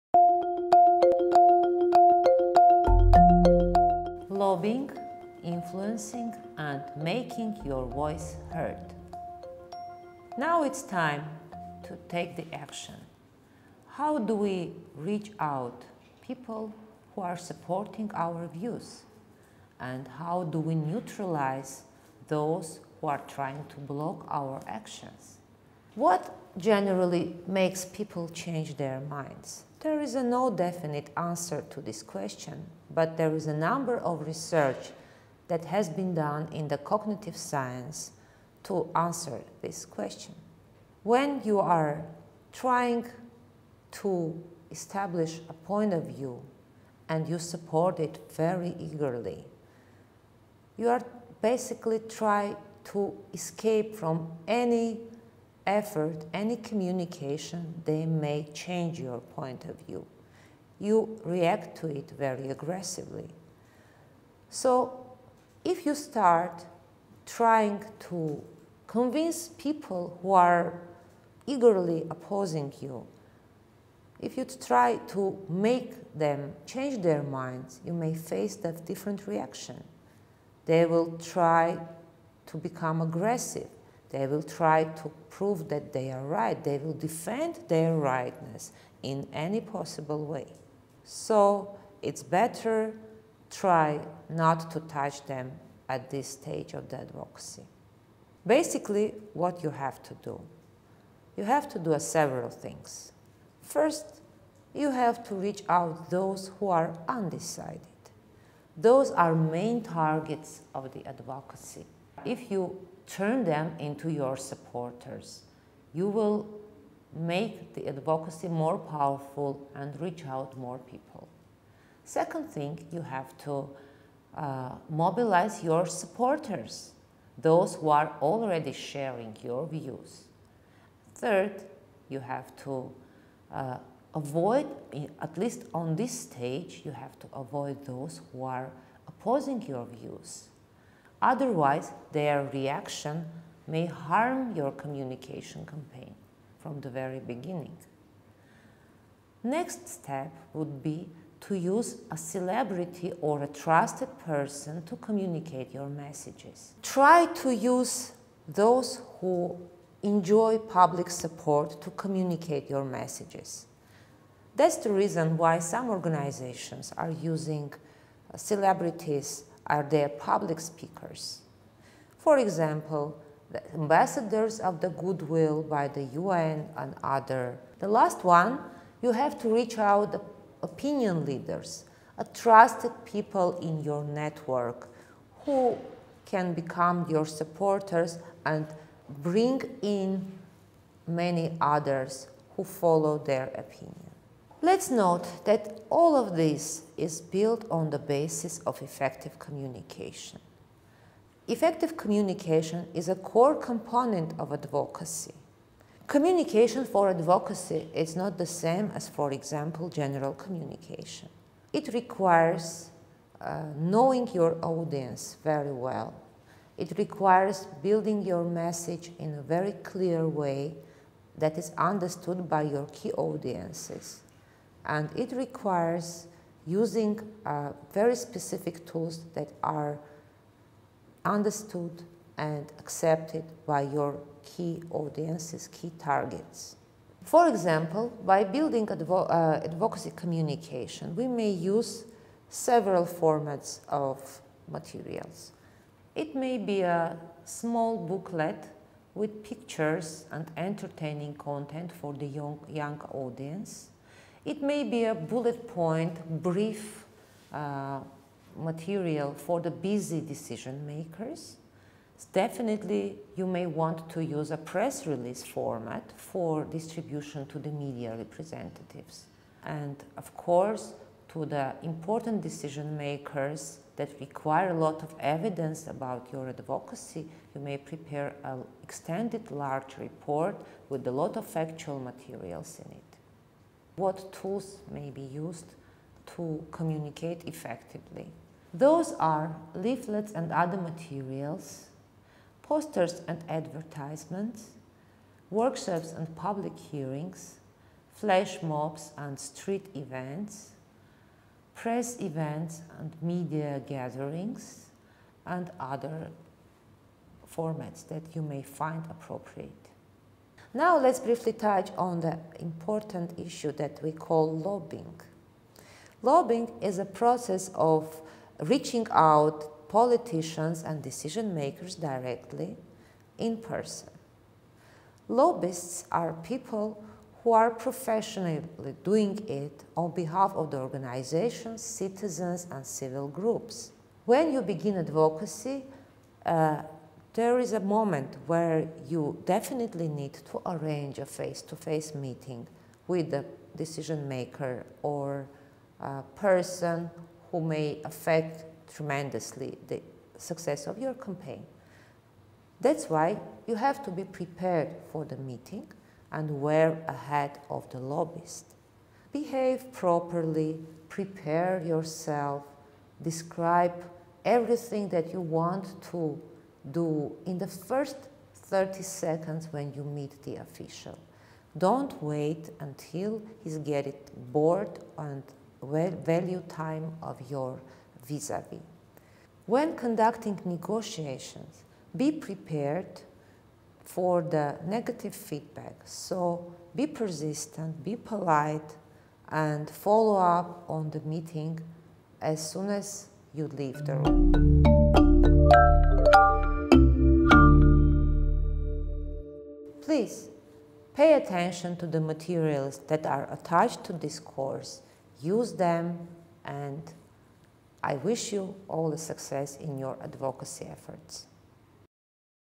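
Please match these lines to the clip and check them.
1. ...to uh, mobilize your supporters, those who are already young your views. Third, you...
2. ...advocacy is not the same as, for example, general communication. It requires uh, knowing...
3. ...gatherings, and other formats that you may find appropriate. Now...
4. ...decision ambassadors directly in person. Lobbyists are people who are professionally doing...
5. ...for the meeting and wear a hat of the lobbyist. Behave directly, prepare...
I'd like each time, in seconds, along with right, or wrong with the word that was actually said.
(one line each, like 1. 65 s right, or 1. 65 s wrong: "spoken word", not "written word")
1. 123 s wrong: "sharing", not "young"
2. 207 s right
3. 303 s right
4. 321 s wrong: "makers", not "ambassadors"
5. 355 s wrong: "properly", not "directly".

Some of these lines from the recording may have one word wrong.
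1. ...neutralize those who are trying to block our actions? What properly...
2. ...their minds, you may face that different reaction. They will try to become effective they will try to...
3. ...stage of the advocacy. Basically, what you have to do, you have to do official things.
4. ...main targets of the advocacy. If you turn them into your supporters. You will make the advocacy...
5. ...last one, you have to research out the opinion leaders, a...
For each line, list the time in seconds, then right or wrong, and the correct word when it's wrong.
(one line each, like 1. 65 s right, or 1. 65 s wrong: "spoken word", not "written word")
1. 20 s wrong: "generally", not "properly"
2. 77 s wrong: "aggressive", not "effective"
3. 96 s wrong: "several", not "official"
4. 109 s right
5. 177 s wrong: "reach", not "research".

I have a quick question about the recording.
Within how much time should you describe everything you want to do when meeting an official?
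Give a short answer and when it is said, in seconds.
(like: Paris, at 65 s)
30 seconds, at 368 s.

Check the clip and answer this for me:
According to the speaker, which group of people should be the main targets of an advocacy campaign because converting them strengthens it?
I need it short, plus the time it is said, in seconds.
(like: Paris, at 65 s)
Those who are undecided, at 106 s.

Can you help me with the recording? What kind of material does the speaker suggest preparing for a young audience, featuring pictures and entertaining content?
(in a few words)
A small booklet.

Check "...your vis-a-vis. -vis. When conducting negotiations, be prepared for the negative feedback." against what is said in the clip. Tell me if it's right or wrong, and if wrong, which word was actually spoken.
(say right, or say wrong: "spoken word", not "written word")
right.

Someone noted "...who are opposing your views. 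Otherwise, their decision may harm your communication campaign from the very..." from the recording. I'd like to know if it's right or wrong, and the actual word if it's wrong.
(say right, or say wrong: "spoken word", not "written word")
wrong: "reaction", not "decision".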